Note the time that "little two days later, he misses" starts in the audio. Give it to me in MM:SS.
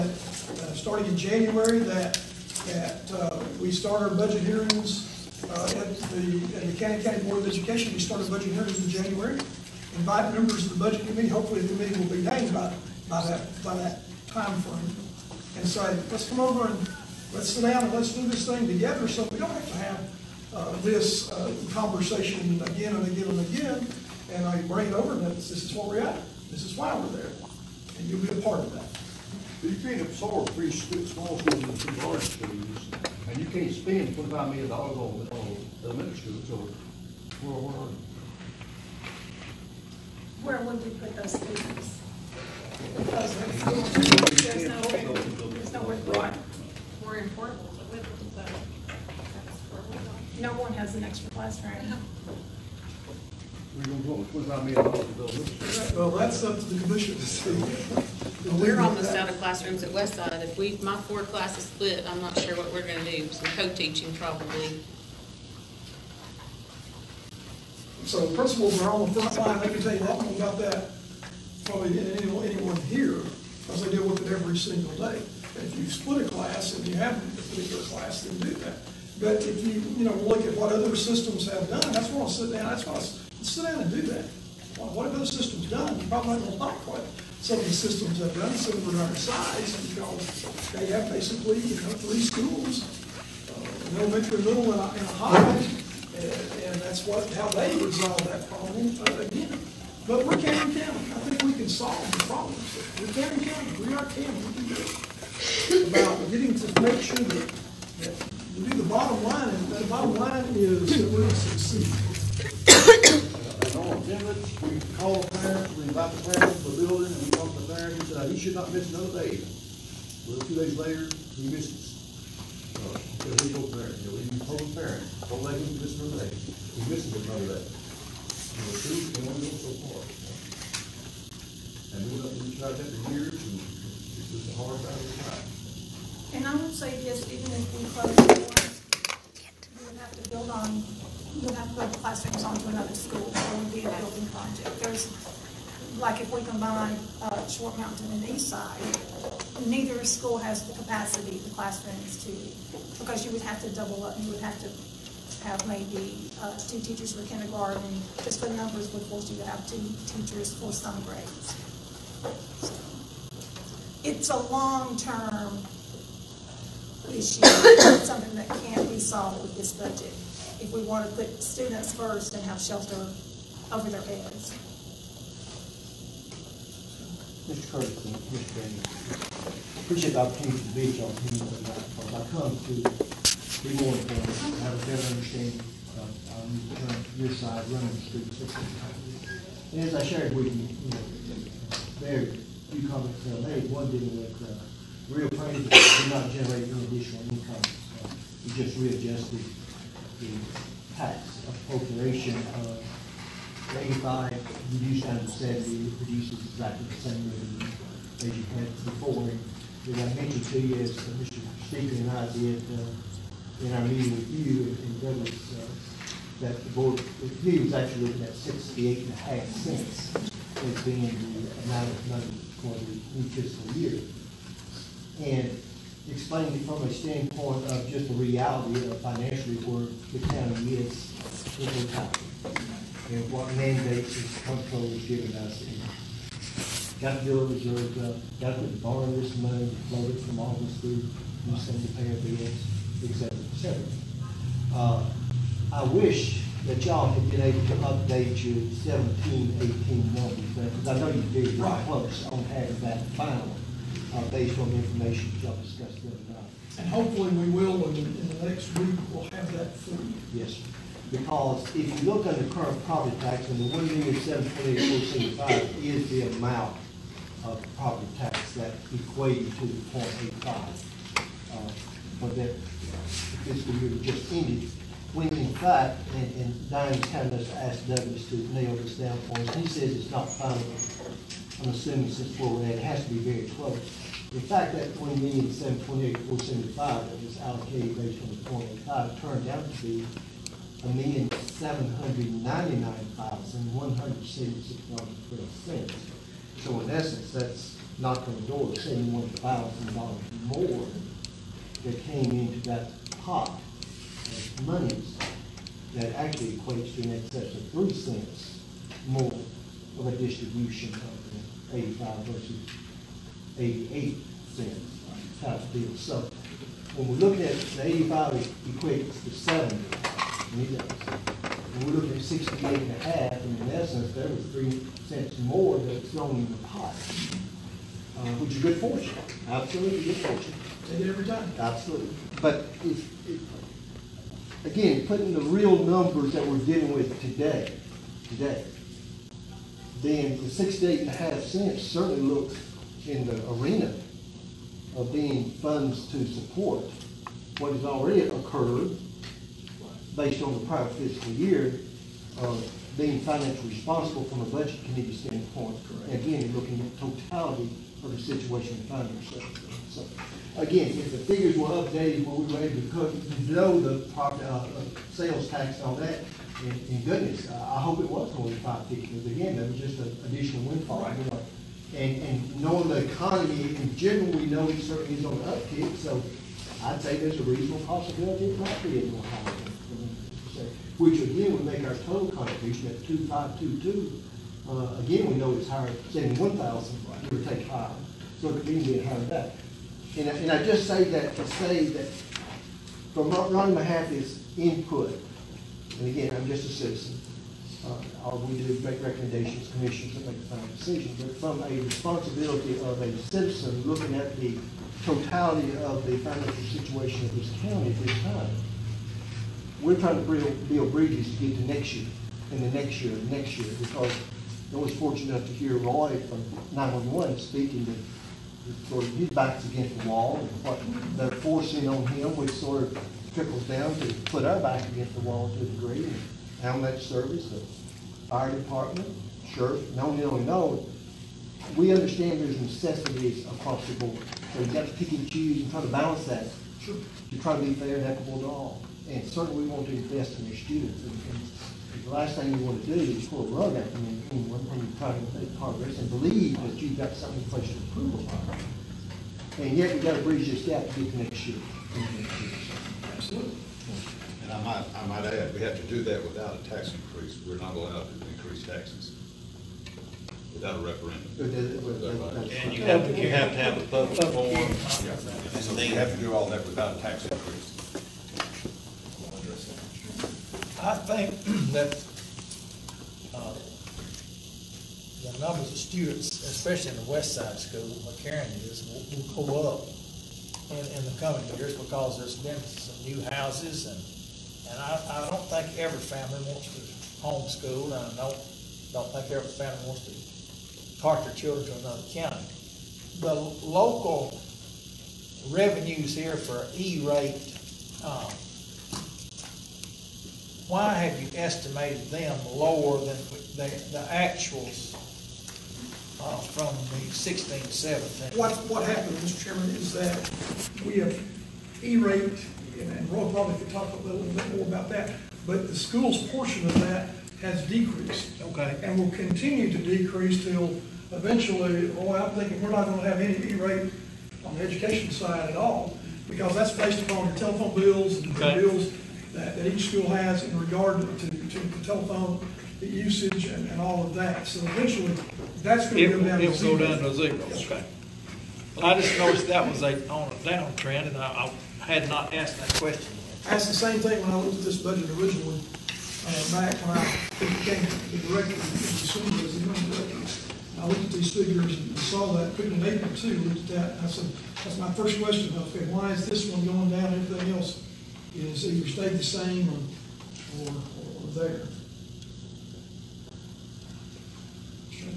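02:00.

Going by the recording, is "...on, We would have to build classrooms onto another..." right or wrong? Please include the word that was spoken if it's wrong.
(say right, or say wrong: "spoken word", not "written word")
right.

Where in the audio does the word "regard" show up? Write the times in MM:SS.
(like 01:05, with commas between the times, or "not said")
08:50.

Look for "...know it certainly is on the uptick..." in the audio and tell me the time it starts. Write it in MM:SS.
06:14.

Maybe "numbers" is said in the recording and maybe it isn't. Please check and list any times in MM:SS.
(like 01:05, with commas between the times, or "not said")
02:38, 04:10, 05:35, 07:55.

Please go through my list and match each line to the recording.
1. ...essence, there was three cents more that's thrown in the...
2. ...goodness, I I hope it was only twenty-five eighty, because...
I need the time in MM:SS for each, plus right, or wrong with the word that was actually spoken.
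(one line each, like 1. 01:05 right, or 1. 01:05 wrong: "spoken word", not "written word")
1. 05:23 right
2. 06:07 wrong: "fifty", not "eighty".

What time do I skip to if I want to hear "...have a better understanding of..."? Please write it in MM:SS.
03:04.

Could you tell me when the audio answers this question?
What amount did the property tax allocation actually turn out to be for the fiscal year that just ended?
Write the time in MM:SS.
04:50.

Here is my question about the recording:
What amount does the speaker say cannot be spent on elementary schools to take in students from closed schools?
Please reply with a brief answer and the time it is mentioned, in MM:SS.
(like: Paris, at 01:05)
$25 million, at 00:34.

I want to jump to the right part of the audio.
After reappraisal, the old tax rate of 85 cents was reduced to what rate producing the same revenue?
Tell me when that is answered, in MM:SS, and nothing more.
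03:24.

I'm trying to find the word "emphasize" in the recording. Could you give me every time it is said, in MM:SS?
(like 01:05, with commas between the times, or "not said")
not said.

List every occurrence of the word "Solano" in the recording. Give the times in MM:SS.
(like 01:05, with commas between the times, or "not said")
not said.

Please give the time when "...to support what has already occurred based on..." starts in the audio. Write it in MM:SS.
05:46.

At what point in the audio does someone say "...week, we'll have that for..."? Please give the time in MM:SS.
04:18.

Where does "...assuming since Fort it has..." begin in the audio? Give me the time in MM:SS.
04:41.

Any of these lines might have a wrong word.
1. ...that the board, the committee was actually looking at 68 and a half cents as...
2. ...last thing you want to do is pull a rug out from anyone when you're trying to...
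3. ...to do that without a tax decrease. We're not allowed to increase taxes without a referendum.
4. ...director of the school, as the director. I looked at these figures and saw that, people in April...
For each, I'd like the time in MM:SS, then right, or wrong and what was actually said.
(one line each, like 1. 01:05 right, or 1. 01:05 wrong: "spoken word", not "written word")
1. 03:36 right
2. 07:22 right
3. 07:35 wrong: "increase", not "decrease"
4. 09:08 right.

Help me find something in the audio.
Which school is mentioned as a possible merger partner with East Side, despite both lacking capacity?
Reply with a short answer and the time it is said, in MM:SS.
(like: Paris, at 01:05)
Short Mountain, at 02:27.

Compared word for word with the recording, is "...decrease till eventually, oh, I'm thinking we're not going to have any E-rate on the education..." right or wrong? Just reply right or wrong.
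right.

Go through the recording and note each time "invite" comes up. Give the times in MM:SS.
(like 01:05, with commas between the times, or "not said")
00:09, 01:55, 04:35.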